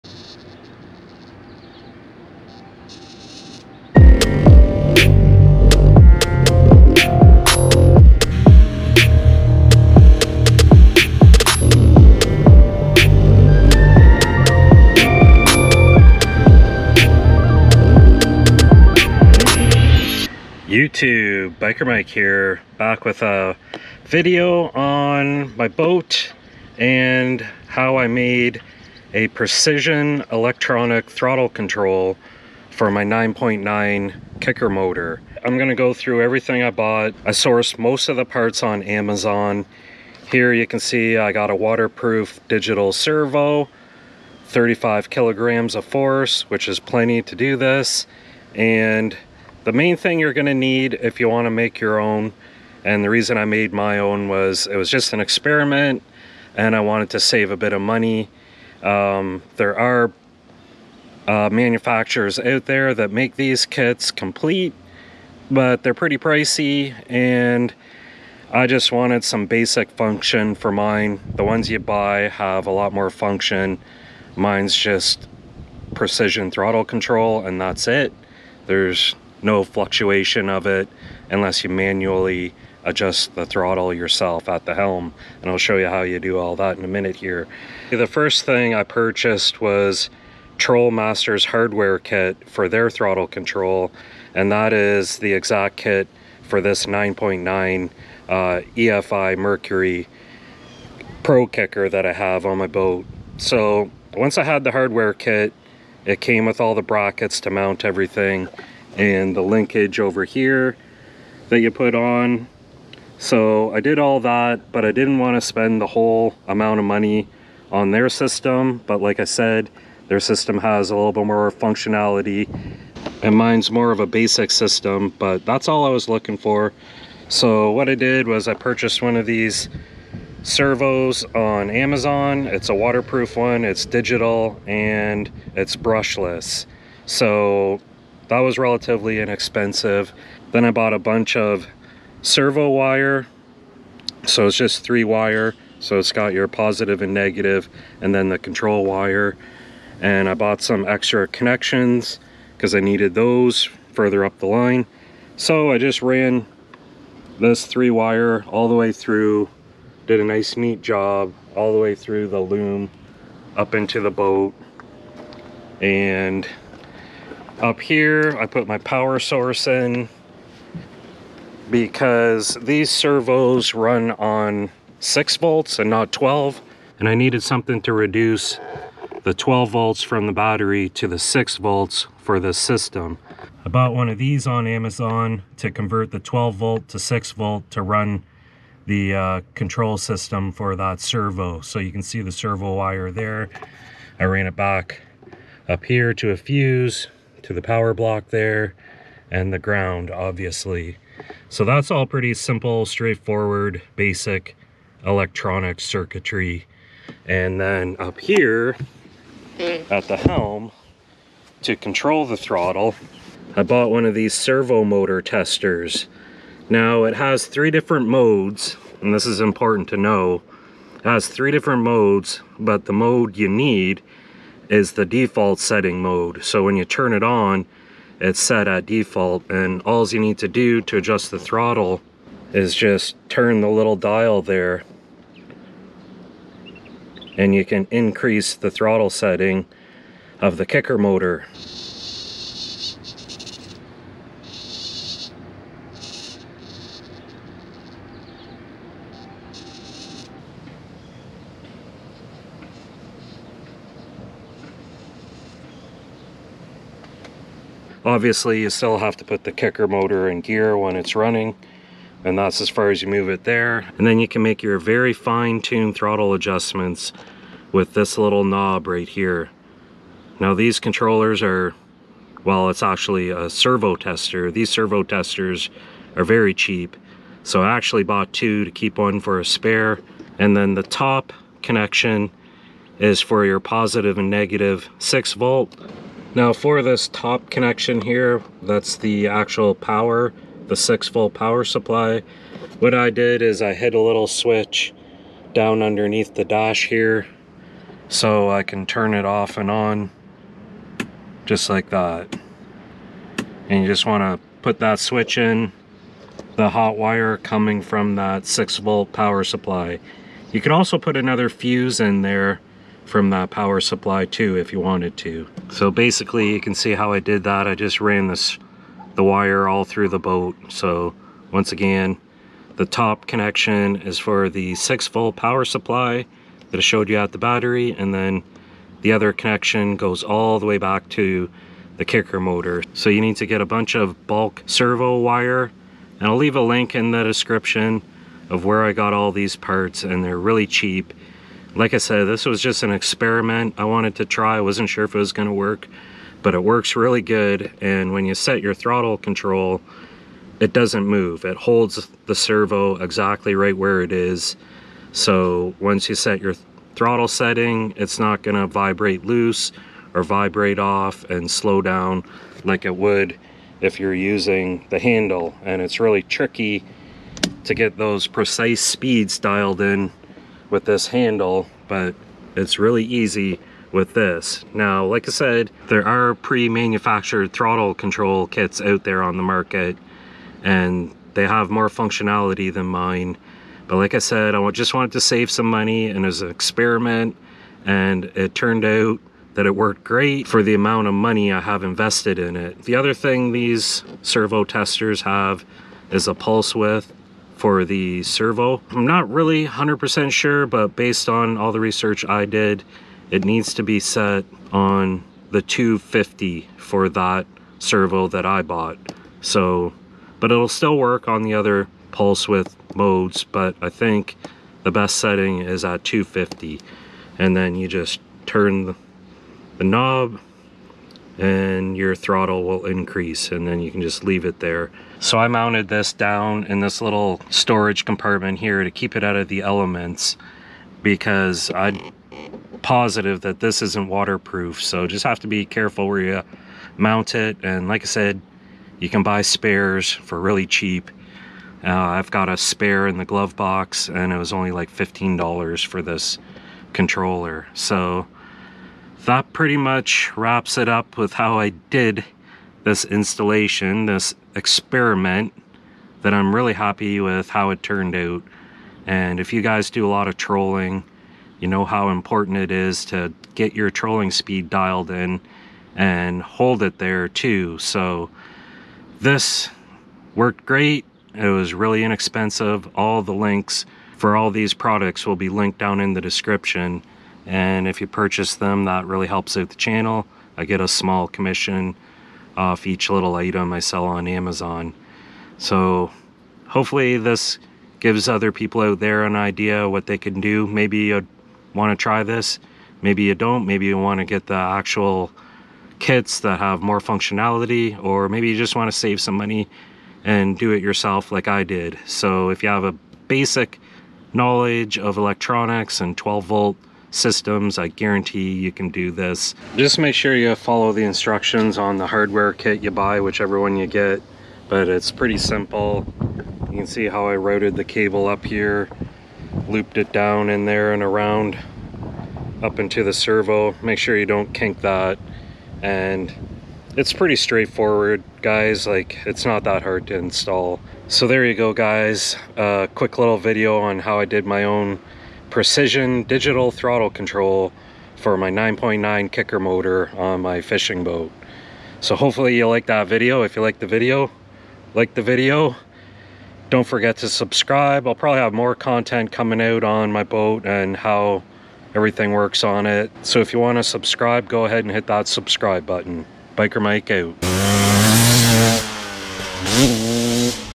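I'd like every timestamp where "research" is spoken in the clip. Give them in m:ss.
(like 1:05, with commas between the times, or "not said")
6:41.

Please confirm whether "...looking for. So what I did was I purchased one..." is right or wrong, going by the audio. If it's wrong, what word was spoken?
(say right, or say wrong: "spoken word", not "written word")
right.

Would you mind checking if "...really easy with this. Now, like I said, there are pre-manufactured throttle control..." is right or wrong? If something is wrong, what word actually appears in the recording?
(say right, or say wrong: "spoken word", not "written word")
right.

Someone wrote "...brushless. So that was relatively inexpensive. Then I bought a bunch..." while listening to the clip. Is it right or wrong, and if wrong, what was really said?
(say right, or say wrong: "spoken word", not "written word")
right.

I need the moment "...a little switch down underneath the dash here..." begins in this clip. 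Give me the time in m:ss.
4:53.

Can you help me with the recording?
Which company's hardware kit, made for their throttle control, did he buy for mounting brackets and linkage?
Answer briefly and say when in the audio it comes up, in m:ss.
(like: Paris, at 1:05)
Troll Masters, at 1:30.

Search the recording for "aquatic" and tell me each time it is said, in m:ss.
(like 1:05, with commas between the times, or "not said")
not said.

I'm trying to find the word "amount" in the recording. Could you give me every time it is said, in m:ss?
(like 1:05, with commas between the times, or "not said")
1:56, 6:30.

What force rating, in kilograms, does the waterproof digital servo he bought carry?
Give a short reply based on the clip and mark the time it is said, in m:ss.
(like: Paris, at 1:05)
35 kilograms, at 0:44.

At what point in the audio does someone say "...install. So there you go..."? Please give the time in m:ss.
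8:50.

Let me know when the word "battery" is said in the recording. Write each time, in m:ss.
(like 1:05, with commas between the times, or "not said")
3:00, 5:27.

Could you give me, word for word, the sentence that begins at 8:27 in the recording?
I guarantee you can do this.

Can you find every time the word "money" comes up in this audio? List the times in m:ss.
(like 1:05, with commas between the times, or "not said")
0:57, 1:56, 6:25, 6:31, 8:19.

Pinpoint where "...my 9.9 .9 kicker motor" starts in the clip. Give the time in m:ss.
0:32.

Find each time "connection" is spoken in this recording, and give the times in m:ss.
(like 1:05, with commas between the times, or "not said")
2:31, 4:41, 4:47, 5:23, 5:29.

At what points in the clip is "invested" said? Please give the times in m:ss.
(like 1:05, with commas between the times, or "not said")
6:31.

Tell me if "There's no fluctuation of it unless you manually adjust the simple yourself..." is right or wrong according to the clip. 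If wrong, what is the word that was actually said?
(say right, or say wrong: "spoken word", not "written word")
wrong: "throttle", not "simple".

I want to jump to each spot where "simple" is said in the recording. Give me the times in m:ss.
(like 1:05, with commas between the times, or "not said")
3:22, 8:35.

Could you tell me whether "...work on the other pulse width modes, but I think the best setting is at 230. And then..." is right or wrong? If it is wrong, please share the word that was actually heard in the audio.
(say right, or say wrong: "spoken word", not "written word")
wrong: "250", not "230".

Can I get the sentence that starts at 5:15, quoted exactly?
So basically you can see how I did that.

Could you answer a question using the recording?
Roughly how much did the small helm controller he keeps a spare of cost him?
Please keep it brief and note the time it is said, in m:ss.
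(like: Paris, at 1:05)
$15, at 7:24.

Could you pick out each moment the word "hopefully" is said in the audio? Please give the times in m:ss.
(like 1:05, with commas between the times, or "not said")
8:06, 9:02.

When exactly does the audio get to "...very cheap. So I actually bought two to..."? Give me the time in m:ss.
4:36.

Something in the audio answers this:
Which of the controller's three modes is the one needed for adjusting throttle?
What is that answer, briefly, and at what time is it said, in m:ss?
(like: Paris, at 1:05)
default setting mode, at 3:45.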